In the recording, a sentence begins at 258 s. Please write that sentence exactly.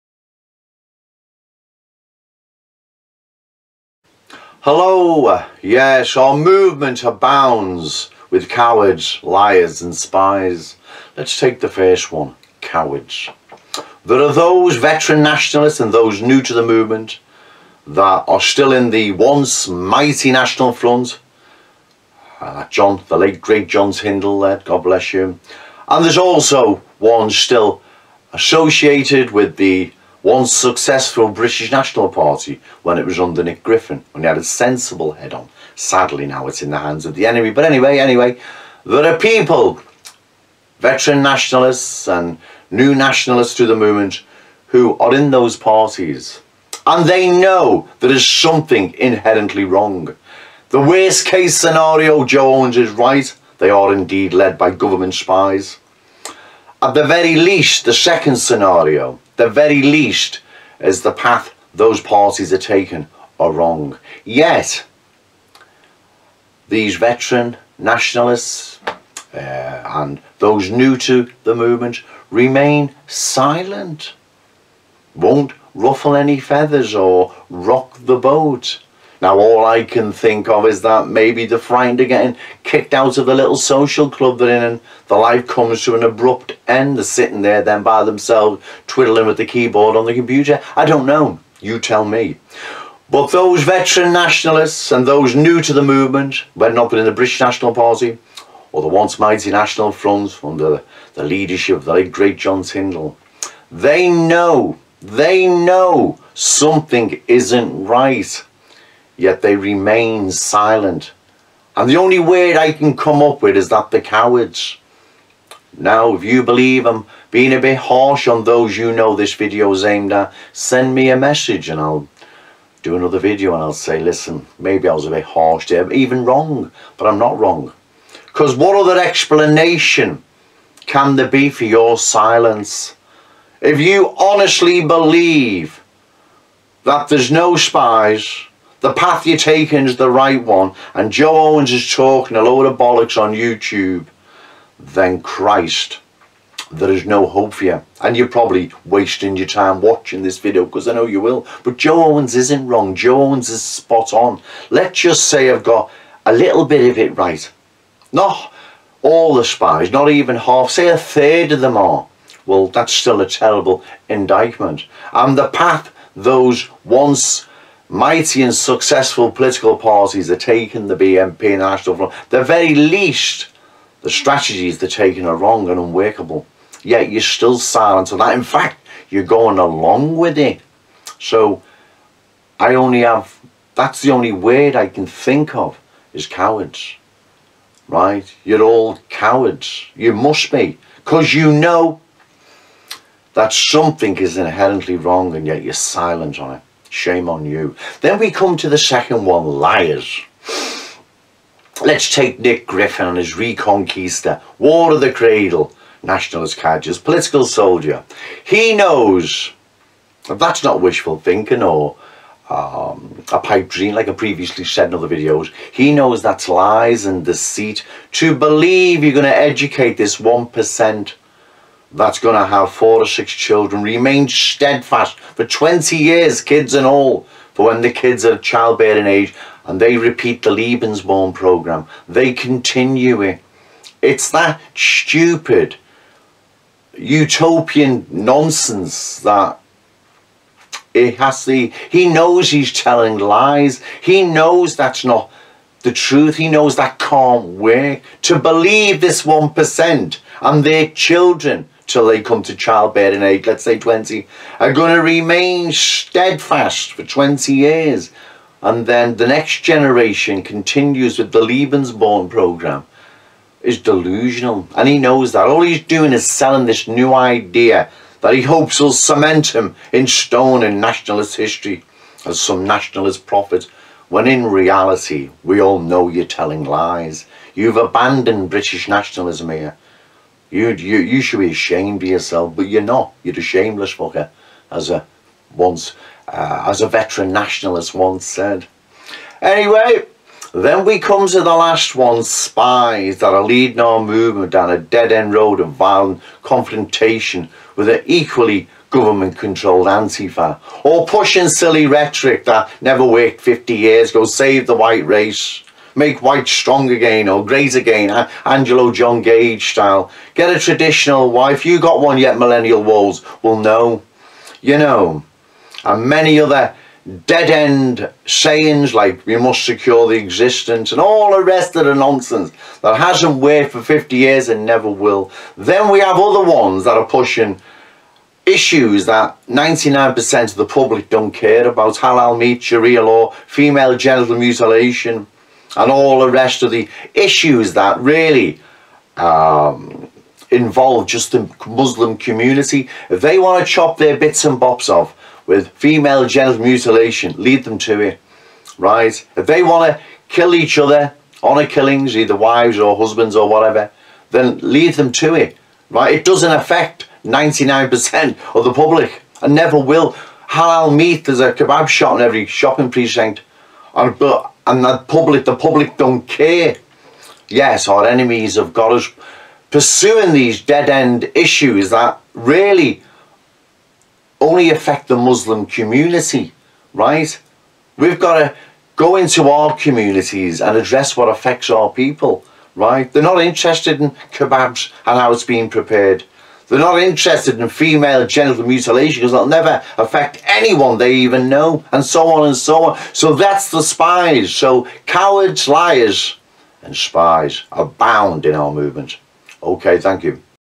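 And then the next generation continues with the Lebensborn program is delusional.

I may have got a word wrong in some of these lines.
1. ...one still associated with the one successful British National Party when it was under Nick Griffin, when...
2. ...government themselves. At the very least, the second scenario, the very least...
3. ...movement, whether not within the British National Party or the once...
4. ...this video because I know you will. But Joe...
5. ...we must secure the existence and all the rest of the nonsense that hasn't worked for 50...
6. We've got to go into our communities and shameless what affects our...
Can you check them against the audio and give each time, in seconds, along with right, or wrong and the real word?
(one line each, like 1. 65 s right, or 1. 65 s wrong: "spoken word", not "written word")
1. 26 s right
2. 54 s wrong: "spies", not "themselves"
3. 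95 s right
4. 150 s right
5. 319 s right
6. 377 s wrong: "address", not "shameless".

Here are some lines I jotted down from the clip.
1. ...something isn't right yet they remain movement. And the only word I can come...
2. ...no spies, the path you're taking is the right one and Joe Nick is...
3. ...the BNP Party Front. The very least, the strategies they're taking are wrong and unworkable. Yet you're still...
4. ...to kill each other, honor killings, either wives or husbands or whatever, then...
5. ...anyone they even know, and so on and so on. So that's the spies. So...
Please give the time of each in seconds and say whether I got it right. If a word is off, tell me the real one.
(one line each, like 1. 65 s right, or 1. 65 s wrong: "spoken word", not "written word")
1. 106 s wrong: "silent", not "movement"
2. 137 s wrong: "Owens", not "Nick"
3. 170 s wrong: "National", not "Party"
4. 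349 s right
5. 390 s right.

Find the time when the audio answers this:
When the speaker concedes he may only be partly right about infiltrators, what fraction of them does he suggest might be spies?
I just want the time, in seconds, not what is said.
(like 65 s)
160 s.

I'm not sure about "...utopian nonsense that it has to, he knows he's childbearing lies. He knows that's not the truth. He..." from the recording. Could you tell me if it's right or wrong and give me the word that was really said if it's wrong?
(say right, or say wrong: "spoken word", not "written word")
wrong: "telling", not "childbearing".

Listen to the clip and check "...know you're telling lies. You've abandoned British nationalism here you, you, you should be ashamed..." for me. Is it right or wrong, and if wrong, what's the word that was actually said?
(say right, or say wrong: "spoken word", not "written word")
right.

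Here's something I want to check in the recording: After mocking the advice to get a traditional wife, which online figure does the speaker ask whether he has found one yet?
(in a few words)
Millennial Woes.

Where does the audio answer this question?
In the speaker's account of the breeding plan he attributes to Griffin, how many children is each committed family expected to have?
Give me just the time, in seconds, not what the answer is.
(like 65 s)
222 s.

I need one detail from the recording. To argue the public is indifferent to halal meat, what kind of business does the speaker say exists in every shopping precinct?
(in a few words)
kebab shop.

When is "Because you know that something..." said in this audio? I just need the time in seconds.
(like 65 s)
190 s.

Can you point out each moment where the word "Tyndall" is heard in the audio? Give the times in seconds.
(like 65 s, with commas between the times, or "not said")
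23 s, 102 s.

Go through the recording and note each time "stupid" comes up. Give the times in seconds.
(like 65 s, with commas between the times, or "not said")
234 s.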